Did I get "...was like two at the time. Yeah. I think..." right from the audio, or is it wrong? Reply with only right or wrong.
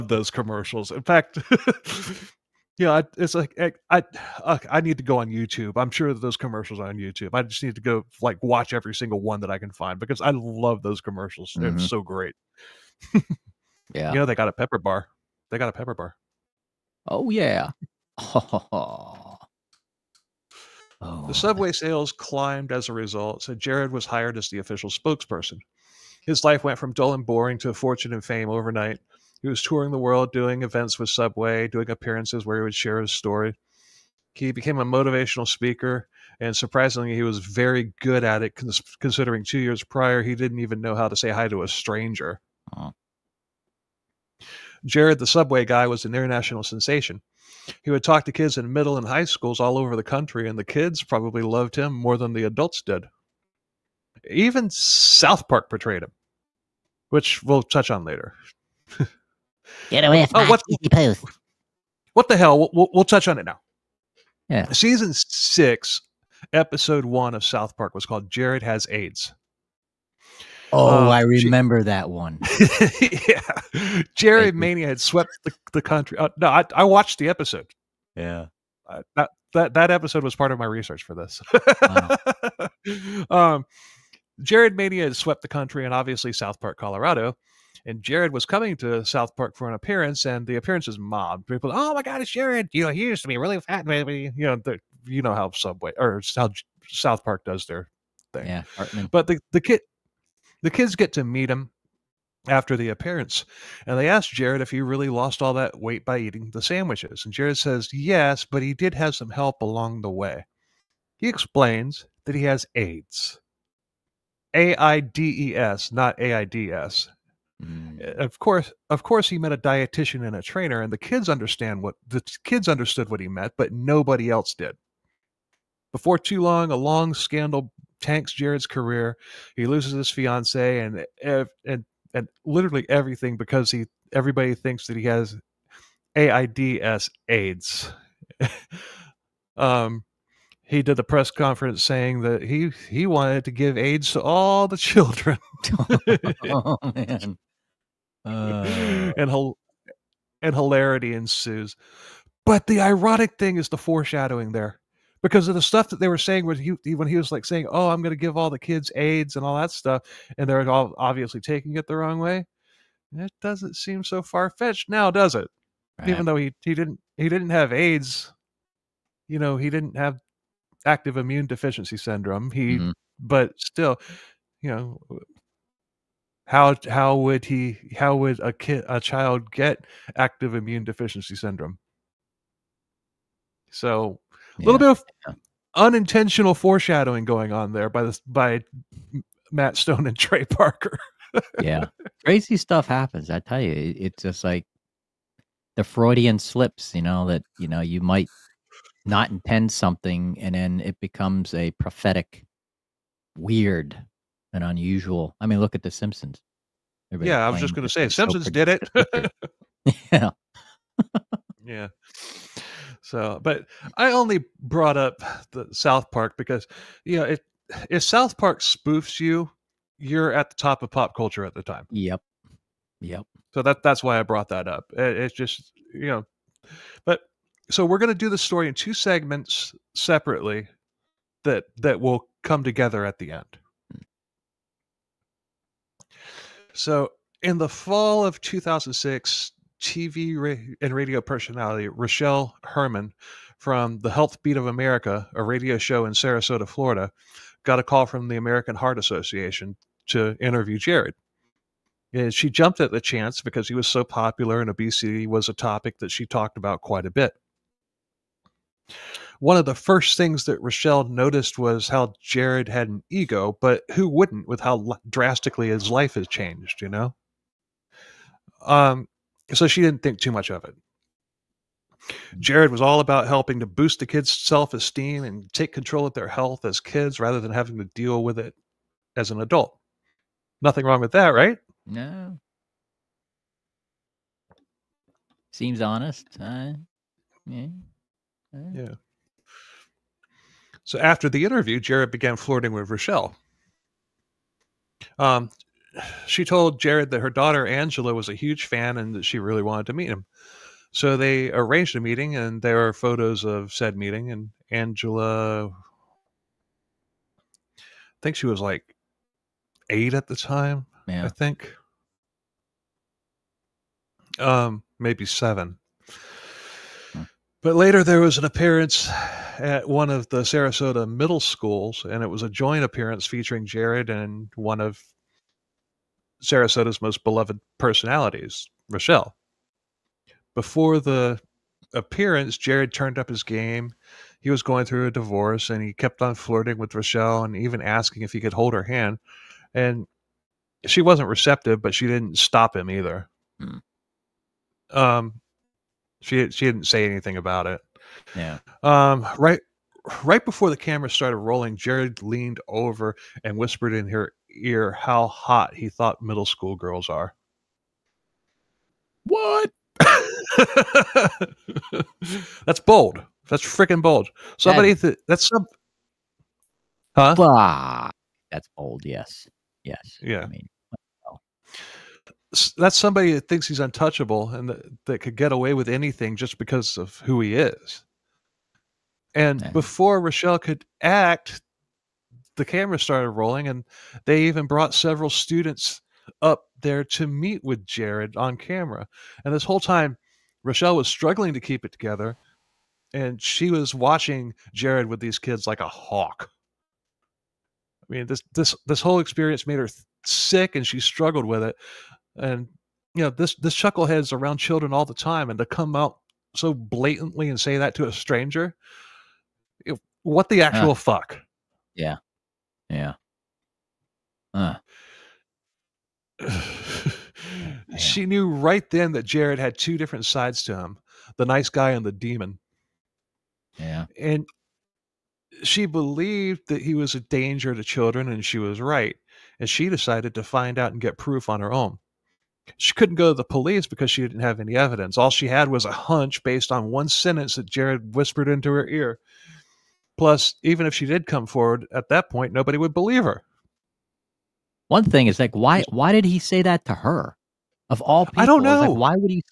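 wrong.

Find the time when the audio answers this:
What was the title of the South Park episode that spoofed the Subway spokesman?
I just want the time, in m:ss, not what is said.
1:08.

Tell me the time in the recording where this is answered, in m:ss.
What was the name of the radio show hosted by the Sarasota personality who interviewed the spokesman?
4:04.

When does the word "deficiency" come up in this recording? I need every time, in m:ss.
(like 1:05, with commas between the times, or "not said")
2:51, 3:00.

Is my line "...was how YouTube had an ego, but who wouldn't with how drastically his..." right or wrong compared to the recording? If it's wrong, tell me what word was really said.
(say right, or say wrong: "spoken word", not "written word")
wrong: "Jared", not "YouTube".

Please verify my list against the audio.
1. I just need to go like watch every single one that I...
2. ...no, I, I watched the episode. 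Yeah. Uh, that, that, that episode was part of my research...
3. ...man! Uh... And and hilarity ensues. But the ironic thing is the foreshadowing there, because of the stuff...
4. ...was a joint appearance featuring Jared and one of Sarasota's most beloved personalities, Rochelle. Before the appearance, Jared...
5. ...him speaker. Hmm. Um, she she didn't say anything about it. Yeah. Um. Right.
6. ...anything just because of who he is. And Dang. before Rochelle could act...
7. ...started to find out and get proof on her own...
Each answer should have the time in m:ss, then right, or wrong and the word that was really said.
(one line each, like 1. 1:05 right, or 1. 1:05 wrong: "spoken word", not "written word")
1. 0:07 right
2. 1:16 right
3. 2:26 right
4. 5:22 right
5. 5:42 wrong: "either", not "speaker"
6. 6:15 right
7. 7:09 wrong: "decided", not "started".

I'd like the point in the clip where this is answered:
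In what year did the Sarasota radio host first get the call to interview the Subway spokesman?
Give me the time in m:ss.
3:58.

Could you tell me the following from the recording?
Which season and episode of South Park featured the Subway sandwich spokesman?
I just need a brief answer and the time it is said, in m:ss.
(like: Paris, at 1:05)
Season 6, episode 1, at 1:04.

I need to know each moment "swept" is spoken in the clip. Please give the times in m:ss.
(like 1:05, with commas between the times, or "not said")
1:15, 1:25.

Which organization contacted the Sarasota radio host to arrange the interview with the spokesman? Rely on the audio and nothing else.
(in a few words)
American Heart Association.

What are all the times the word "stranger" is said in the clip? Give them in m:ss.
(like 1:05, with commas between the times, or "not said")
0:41, 6:48.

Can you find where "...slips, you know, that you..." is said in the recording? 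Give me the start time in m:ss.
3:16.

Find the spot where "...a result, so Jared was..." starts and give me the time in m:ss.
0:22.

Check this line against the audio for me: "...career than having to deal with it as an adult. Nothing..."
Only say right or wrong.
wrong.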